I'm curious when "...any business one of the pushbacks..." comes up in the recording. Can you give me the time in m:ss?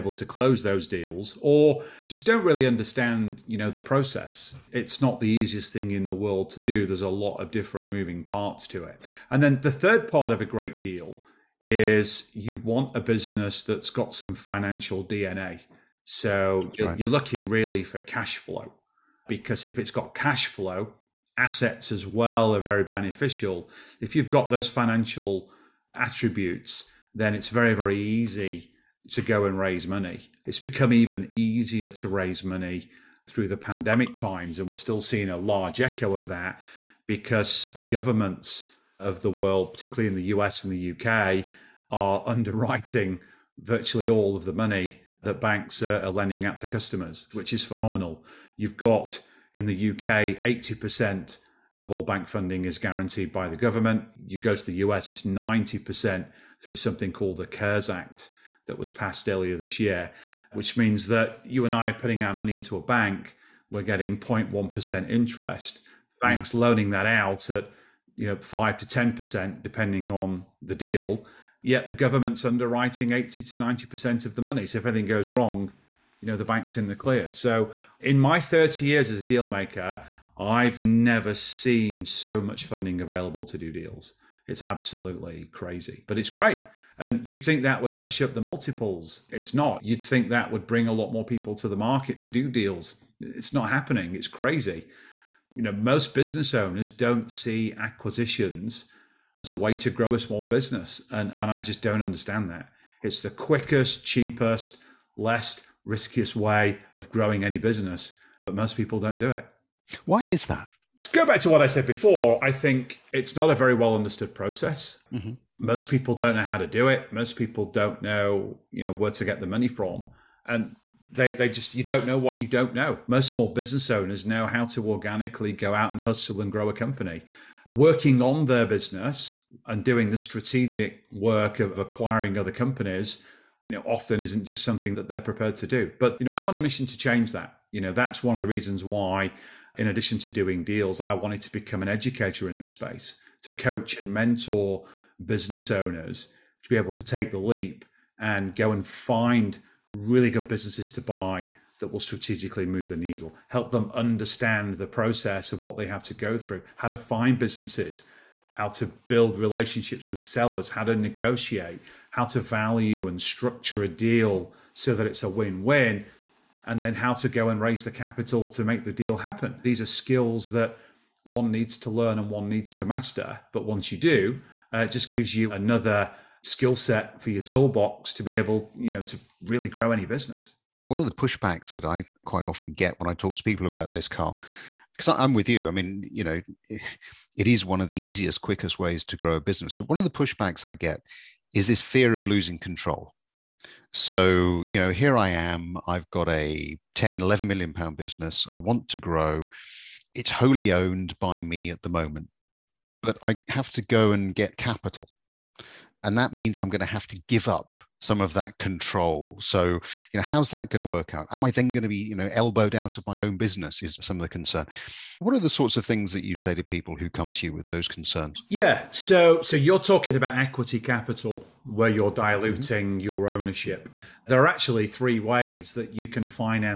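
2:59.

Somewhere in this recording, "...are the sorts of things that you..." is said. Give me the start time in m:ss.
3:35.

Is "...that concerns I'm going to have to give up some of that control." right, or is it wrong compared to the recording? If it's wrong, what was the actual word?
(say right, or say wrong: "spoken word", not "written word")
wrong: "means", not "concerns".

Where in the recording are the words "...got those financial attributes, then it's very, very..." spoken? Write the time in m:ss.
0:24.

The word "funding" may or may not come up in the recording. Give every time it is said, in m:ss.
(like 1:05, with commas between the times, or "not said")
0:52, 1:22.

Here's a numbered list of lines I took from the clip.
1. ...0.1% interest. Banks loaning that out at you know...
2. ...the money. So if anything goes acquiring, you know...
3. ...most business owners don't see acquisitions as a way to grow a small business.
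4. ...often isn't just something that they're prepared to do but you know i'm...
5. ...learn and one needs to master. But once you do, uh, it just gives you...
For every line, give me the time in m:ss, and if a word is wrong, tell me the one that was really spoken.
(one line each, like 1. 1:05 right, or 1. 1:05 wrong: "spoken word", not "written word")
1. 1:04 right
2. 1:14 wrong: "wrong", not "acquiring"
3. 1:35 right
4. 2:13 right
5. 2:51 right.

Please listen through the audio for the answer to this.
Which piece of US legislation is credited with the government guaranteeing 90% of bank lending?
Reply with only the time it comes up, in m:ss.
0:57.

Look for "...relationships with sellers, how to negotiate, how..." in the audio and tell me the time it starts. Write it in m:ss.
2:39.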